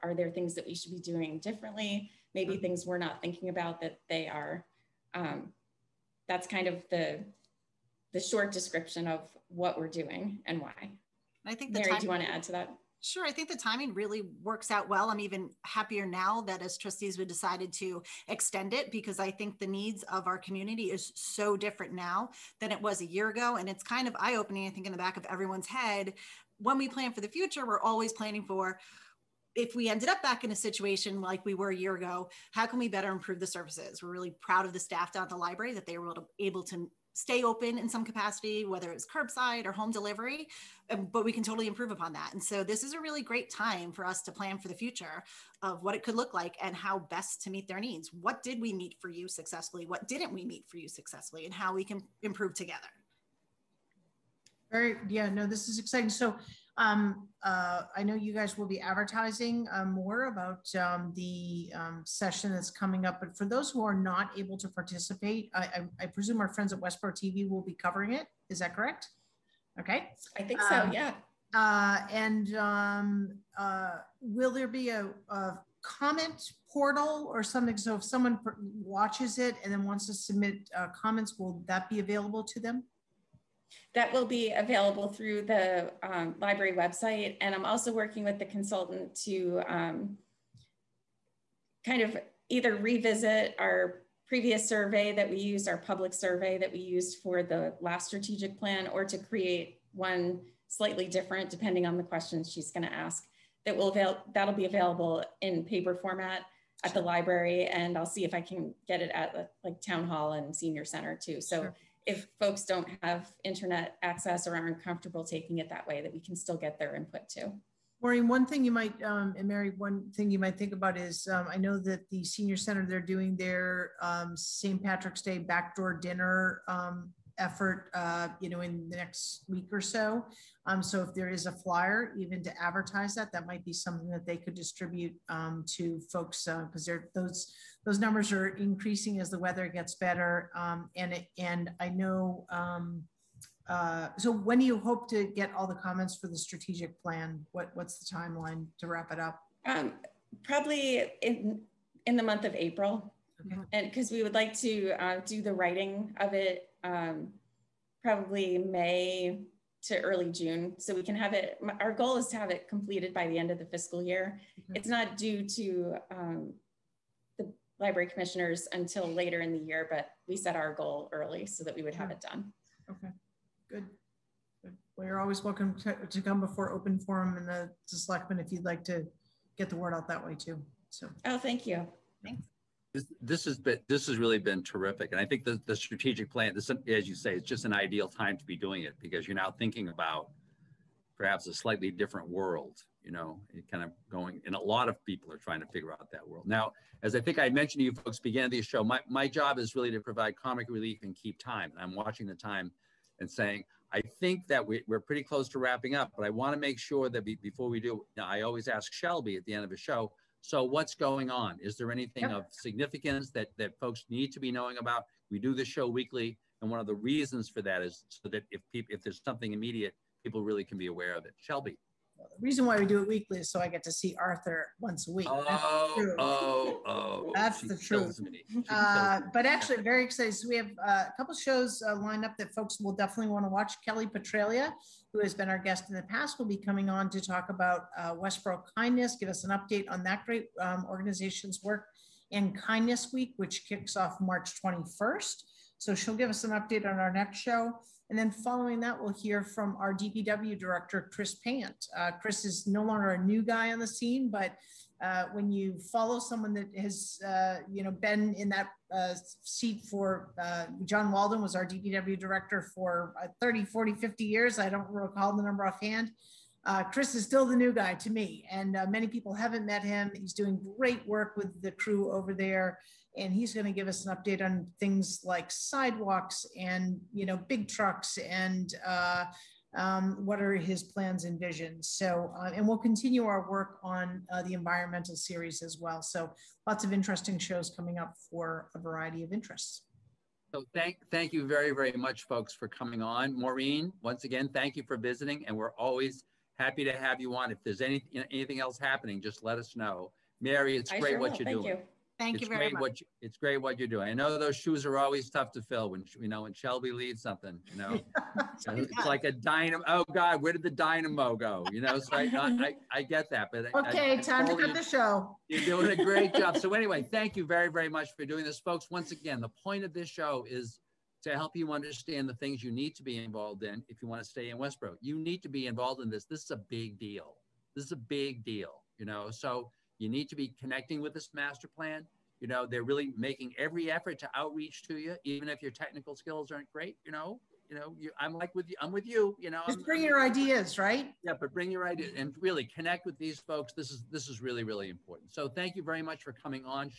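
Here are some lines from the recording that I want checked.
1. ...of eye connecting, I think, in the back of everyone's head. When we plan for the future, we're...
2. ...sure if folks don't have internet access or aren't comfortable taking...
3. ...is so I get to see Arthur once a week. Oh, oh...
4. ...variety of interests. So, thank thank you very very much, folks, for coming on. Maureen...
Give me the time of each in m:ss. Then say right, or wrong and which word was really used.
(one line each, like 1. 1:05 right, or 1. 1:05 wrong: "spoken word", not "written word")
1. 0:24 wrong: "opening", not "connecting"
2. 1:51 right
3. 3:43 right
4. 4:48 right.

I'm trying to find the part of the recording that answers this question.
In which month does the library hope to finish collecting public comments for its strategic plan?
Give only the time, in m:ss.
2:32.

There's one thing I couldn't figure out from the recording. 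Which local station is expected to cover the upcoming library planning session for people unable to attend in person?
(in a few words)
Westboro TV.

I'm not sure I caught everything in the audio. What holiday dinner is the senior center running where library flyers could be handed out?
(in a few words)
St. Patrick's Day.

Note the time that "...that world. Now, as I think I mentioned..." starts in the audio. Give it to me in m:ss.
3:16.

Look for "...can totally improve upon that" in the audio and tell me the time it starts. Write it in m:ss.
0:41.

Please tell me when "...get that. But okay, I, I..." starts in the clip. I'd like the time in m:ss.
5:13.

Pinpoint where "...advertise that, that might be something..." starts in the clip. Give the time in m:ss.
2:12.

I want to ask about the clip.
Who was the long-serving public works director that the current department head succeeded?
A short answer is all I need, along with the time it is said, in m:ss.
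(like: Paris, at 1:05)
John Walden, at 4:20.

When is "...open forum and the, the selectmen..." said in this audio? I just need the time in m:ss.
2:56.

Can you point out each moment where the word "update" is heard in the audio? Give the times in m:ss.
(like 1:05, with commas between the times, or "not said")
3:59, 4:06, 4:34.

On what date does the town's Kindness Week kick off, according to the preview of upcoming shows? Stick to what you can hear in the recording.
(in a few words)
March 21st.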